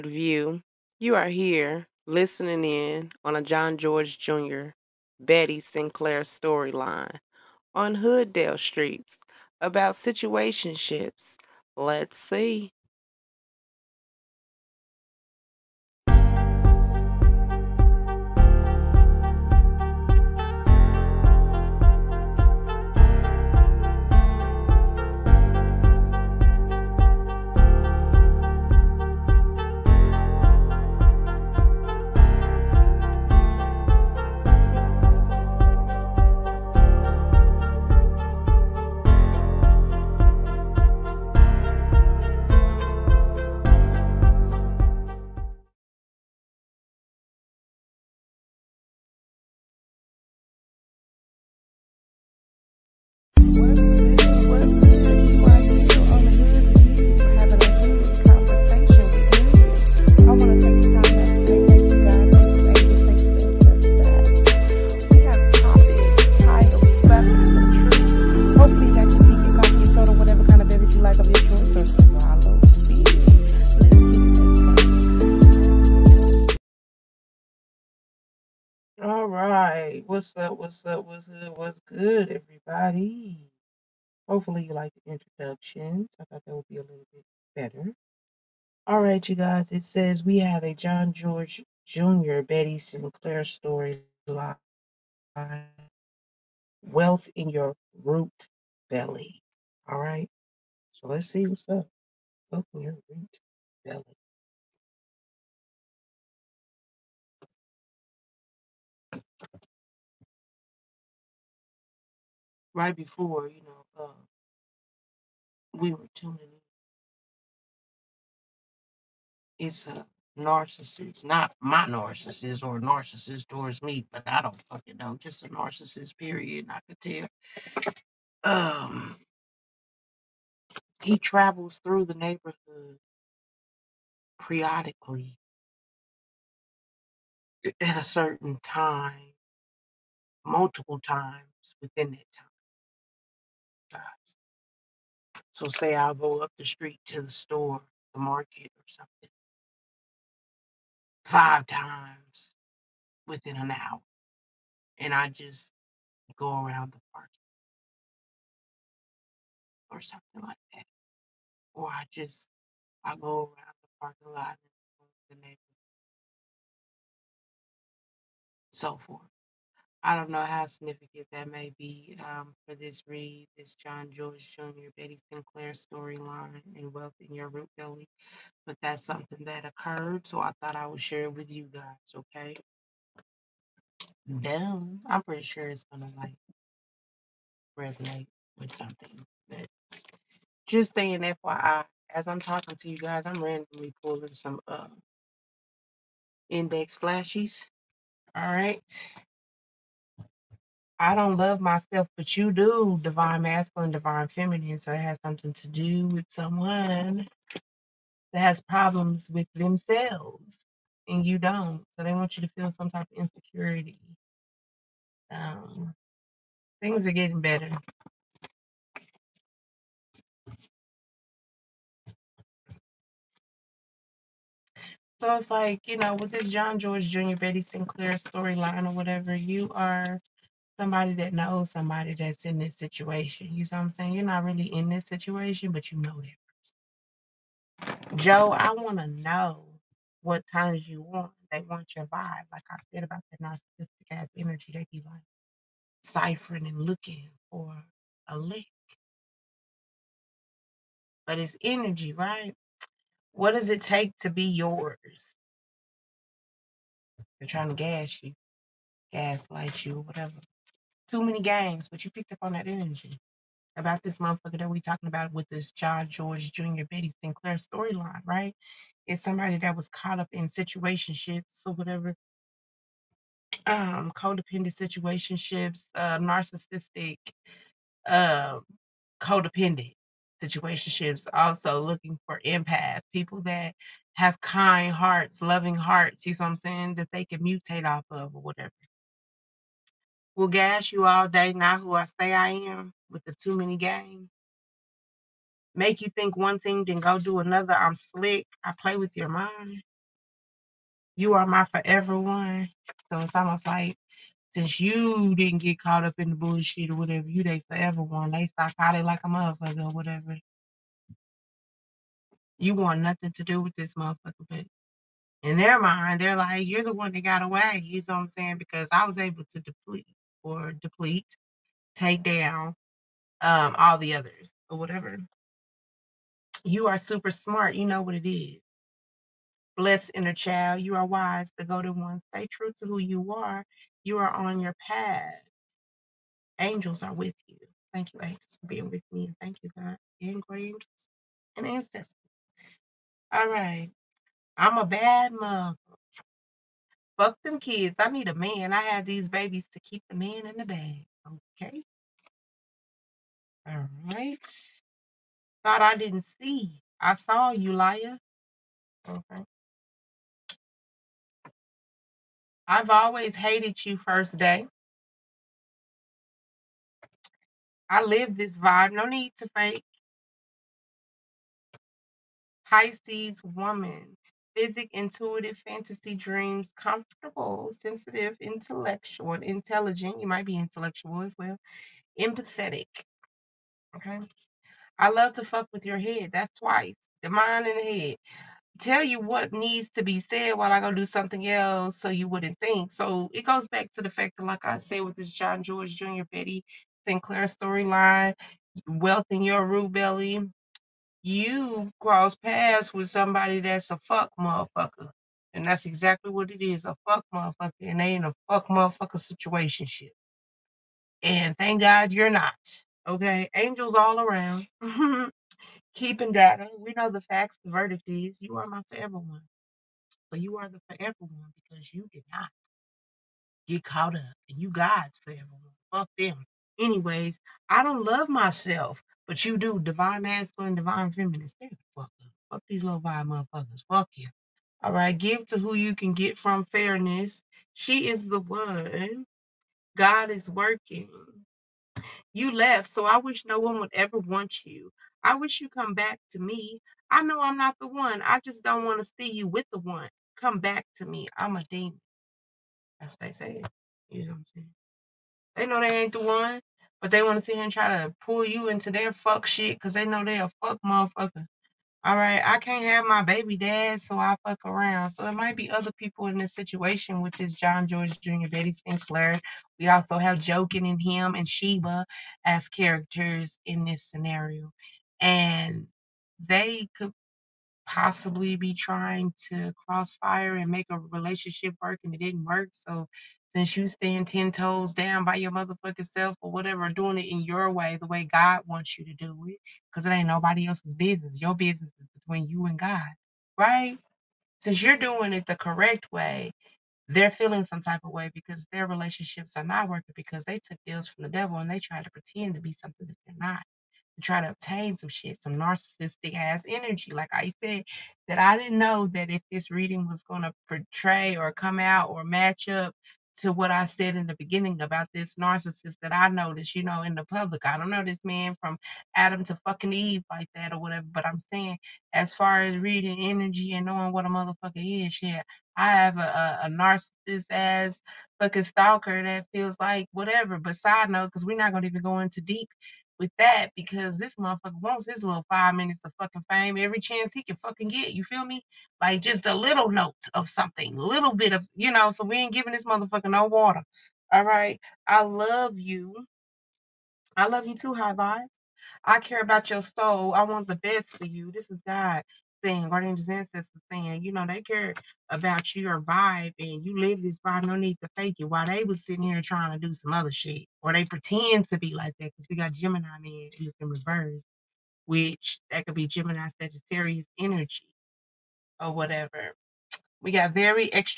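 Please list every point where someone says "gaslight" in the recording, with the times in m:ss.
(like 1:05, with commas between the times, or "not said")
4:19.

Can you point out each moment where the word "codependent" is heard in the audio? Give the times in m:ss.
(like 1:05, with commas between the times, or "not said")
4:34, 4:39.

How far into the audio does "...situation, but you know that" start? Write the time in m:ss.
3:55.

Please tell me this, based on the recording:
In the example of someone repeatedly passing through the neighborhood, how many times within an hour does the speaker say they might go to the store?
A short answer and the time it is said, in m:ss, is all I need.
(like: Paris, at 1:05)
5, at 2:31.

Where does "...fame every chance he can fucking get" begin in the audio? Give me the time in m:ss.
8:56.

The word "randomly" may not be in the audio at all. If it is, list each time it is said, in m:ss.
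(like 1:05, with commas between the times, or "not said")
3:13.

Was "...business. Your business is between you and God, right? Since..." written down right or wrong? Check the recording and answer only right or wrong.
right.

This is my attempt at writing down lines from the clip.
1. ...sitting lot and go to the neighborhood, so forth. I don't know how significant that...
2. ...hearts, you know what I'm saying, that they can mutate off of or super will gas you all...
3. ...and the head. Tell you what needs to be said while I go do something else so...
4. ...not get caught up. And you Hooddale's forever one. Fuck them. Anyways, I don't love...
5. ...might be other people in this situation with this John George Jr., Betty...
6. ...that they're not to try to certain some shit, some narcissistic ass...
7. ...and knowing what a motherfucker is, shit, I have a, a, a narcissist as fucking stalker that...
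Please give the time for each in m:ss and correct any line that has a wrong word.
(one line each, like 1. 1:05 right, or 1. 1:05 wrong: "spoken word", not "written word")
1. 2:44 wrong: "parking", not "sitting"
2. 4:45 wrong: "whatever", not "super"
3. 6:27 right
4. 7:02 wrong: "God", not "Hooddale"
5. 7:45 right
6. 8:23 wrong: "obtain", not "certain"
7. 8:43 right.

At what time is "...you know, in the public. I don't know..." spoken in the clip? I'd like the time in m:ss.
8:36.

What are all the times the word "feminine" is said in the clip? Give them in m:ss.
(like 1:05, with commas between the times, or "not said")
3:24, 7:11.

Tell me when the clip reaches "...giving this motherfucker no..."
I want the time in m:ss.
9:02.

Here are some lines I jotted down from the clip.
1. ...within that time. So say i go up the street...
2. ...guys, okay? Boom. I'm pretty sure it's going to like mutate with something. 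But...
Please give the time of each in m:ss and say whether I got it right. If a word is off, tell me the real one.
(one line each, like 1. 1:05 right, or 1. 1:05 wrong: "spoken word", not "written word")
1. 2:21 right
2. 3:01 wrong: "resonate", not "mutate".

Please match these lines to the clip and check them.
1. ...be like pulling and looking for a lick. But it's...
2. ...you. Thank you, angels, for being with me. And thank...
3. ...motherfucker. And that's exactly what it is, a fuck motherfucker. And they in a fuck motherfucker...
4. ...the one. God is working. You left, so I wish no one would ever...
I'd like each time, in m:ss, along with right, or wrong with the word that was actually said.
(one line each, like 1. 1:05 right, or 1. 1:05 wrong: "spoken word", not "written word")
1. 4:04 wrong: "ciphering", not "pulling"
2. 5:37 right
3. 6:44 right
4. 7:18 right.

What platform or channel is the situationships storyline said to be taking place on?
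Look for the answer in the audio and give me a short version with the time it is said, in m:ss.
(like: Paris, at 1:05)
Hooddale Streets, at 0:07.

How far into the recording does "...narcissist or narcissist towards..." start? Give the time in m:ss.
2:01.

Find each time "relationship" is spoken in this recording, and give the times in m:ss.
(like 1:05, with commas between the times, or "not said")
8:00, 8:18.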